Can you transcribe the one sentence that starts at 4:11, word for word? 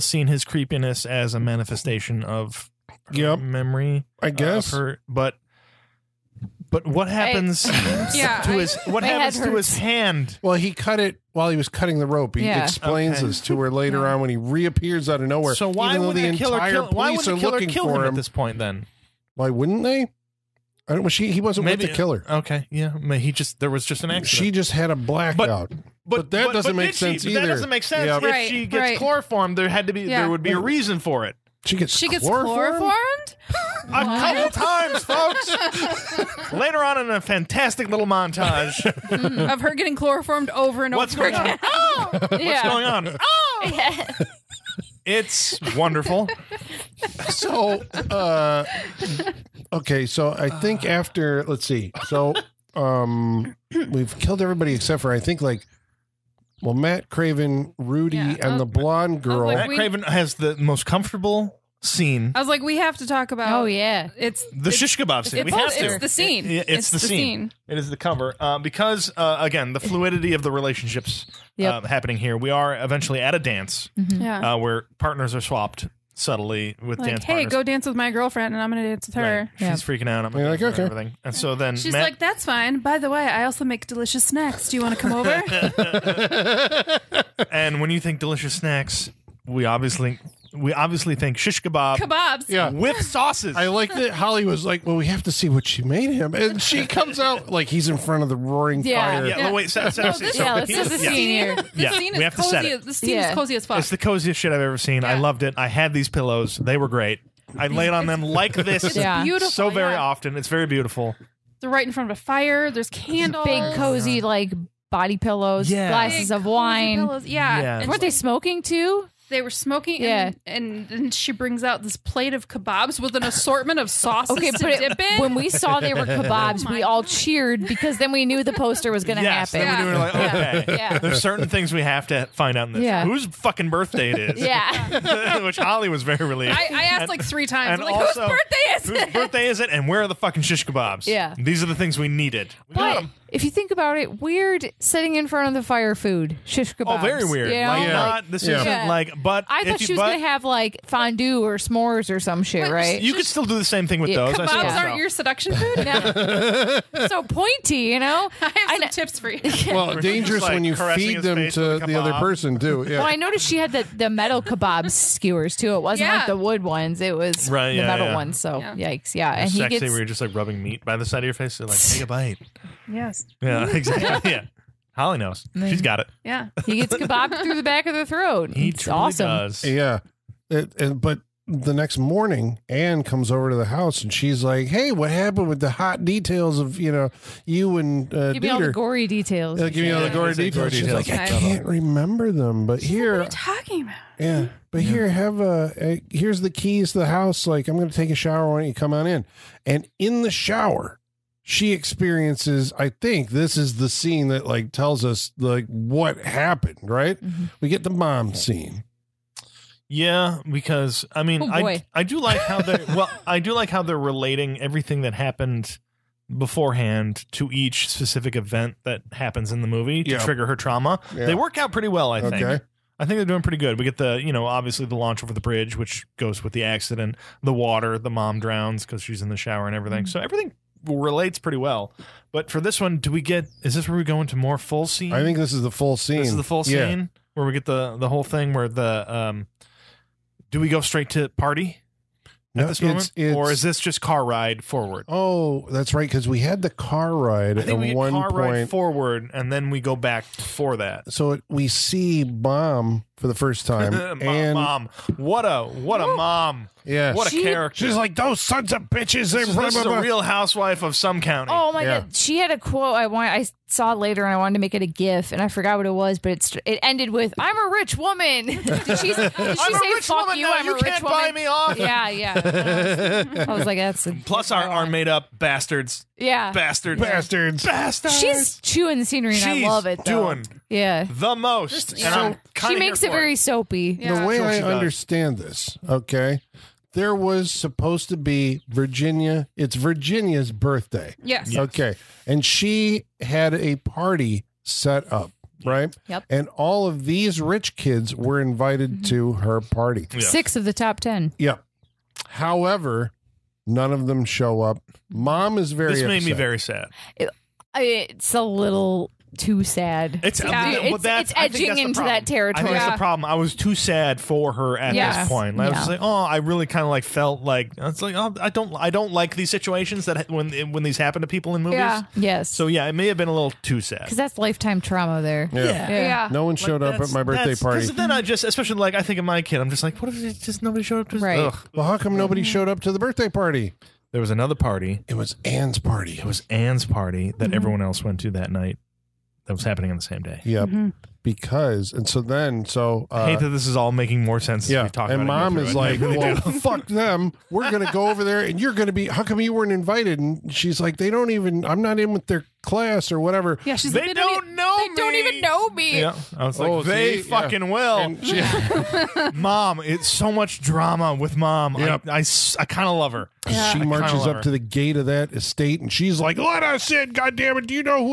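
So it, we see bomb for the first time.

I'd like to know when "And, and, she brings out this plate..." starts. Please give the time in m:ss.
2:00.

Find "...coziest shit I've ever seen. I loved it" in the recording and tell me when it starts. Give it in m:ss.
1:43.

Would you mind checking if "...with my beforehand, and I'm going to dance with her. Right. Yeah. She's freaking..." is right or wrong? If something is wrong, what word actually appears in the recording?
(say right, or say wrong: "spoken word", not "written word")
wrong: "girlfriend", not "beforehand".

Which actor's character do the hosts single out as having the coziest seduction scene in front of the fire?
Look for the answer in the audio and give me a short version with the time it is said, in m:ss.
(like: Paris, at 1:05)
Matt Craven, at 0:56.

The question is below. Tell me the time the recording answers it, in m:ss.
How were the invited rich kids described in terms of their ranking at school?
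5:00.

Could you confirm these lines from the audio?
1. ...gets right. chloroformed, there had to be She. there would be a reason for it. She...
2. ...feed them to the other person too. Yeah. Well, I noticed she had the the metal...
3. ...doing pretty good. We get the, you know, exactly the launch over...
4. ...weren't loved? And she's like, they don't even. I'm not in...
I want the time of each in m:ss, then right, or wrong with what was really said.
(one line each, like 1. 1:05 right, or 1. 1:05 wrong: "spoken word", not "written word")
1. 0:28 wrong: "Yeah", not "She"
2. 2:40 right
3. 3:43 wrong: "obviously", not "exactly"
4. 5:49 wrong: "invited", not "loved".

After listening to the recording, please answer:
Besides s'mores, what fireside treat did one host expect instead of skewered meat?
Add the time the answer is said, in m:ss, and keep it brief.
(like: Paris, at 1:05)
Fondue, at 2:30.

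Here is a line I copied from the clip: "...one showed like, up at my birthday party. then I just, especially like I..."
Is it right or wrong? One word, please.
right.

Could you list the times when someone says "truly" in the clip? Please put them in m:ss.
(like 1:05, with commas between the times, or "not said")
2:58.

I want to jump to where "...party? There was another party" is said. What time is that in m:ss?
5:33.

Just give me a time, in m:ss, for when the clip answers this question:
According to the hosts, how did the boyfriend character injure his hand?
0:11.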